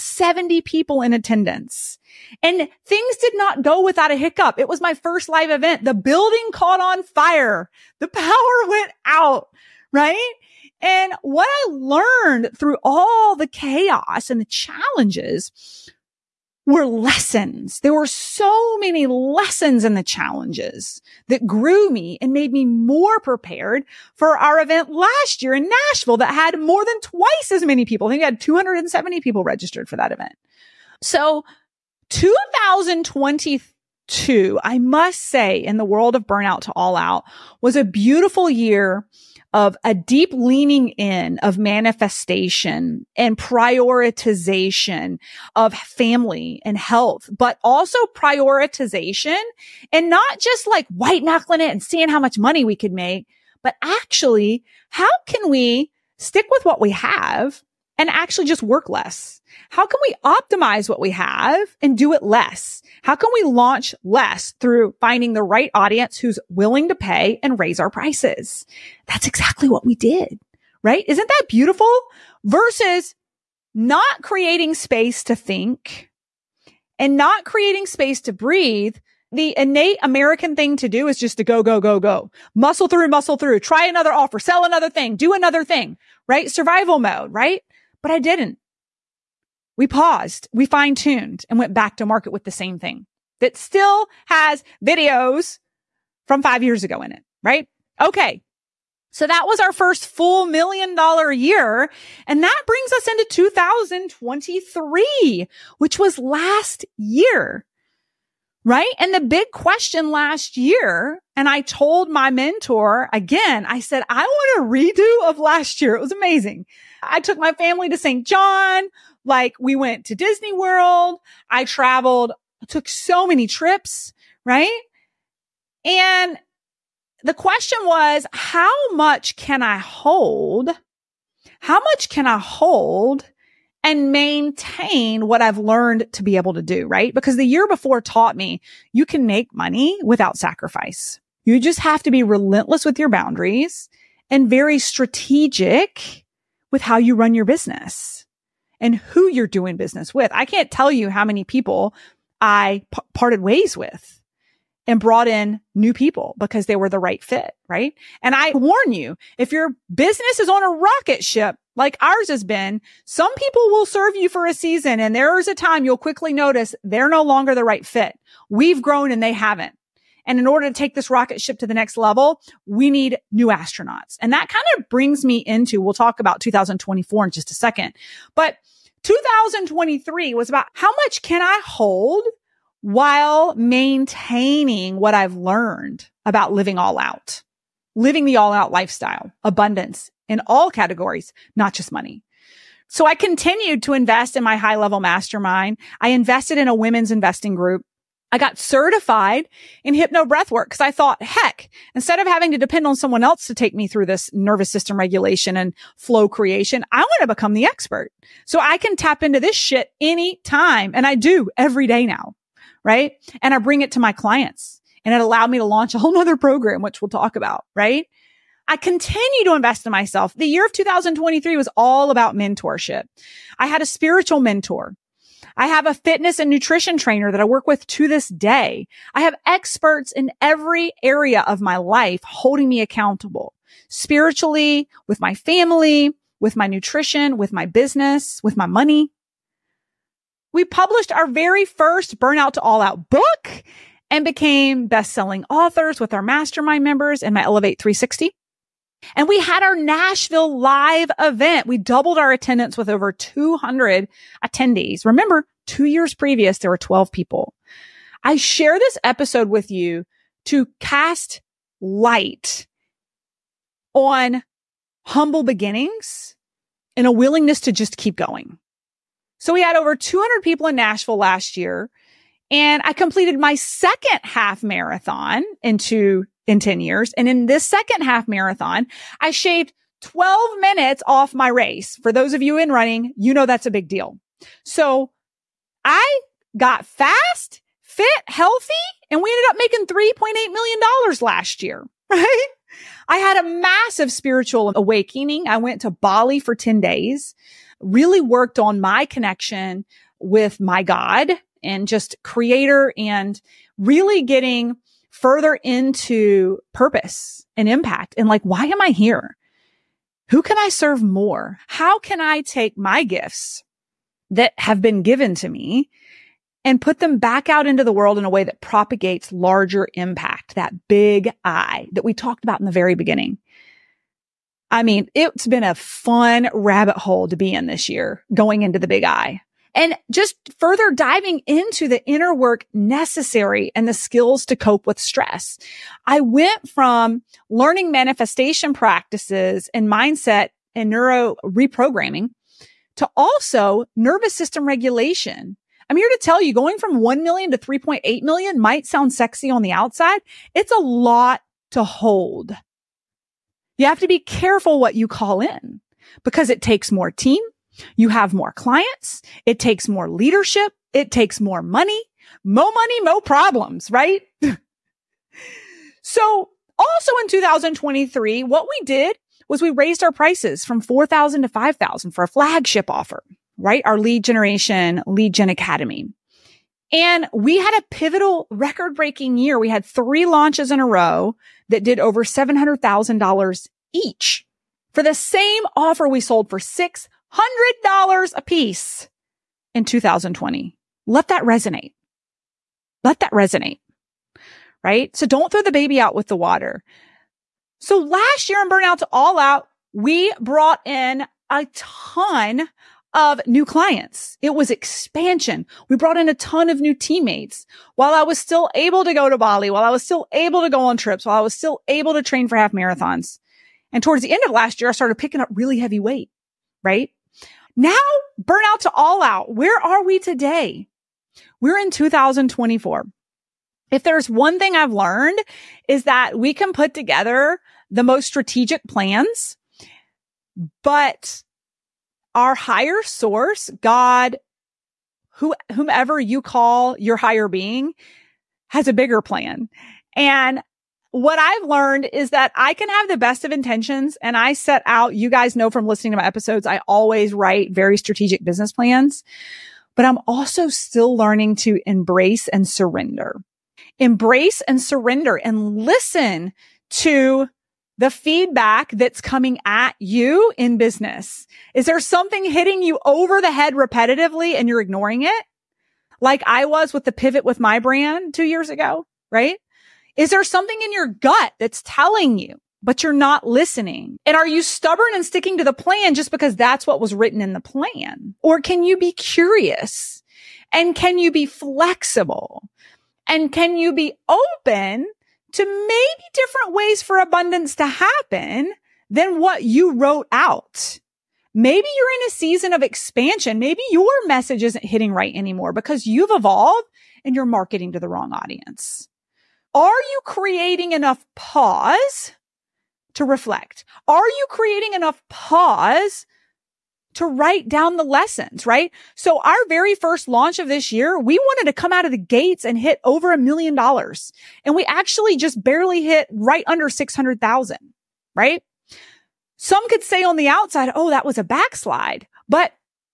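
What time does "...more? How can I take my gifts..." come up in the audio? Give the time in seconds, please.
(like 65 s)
311 s.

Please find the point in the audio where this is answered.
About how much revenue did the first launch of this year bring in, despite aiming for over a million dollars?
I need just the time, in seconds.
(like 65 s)
516 s.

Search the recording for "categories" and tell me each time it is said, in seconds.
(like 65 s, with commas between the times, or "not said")
190 s.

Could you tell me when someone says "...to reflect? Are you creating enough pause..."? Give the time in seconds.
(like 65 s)
503 s.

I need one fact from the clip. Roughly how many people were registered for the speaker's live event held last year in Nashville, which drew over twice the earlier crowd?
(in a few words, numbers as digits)
270.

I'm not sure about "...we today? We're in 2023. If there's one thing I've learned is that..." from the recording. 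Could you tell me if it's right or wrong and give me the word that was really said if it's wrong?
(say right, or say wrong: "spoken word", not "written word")
wrong: "2024", not "2023".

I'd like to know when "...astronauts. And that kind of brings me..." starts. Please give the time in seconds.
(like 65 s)
173 s.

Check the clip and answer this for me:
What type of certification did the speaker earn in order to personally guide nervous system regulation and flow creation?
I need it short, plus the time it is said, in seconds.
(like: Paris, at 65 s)
Hypno breath work, at 199 s.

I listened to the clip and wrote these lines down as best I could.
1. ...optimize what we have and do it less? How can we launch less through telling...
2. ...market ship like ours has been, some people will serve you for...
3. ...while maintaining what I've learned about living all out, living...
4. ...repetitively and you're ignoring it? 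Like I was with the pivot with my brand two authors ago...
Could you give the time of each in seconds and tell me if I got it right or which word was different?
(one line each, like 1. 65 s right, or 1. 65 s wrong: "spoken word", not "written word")
1. 60 s wrong: "finding", not "telling"
2. 160 s wrong: "rocket", not "market"
3. 182 s right
4. 463 s wrong: "years", not "authors".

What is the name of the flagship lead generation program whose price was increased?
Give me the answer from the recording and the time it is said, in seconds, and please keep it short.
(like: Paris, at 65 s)
Lead Gen Academy, at 375 s.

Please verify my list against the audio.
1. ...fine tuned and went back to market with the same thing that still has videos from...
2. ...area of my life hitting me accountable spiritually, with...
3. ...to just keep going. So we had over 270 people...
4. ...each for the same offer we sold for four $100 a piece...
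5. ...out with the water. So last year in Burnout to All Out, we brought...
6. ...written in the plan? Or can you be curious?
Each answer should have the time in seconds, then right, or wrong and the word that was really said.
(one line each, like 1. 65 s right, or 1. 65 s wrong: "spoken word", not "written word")
1. 90 s right
2. 231 s wrong: "holding", not "hitting"
3. 267 s wrong: "200", not "270"
4. 383 s wrong: "six", not "four"
5. 395 s right
6. 477 s right.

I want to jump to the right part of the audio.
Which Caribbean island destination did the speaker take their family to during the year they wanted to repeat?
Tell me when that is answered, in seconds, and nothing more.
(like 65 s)
117 s.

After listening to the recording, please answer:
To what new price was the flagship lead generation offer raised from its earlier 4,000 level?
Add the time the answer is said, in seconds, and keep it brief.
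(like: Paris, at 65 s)
5,000, at 371 s.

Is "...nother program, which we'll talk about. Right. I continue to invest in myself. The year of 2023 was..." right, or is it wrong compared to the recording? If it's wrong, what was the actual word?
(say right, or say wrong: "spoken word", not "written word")
right.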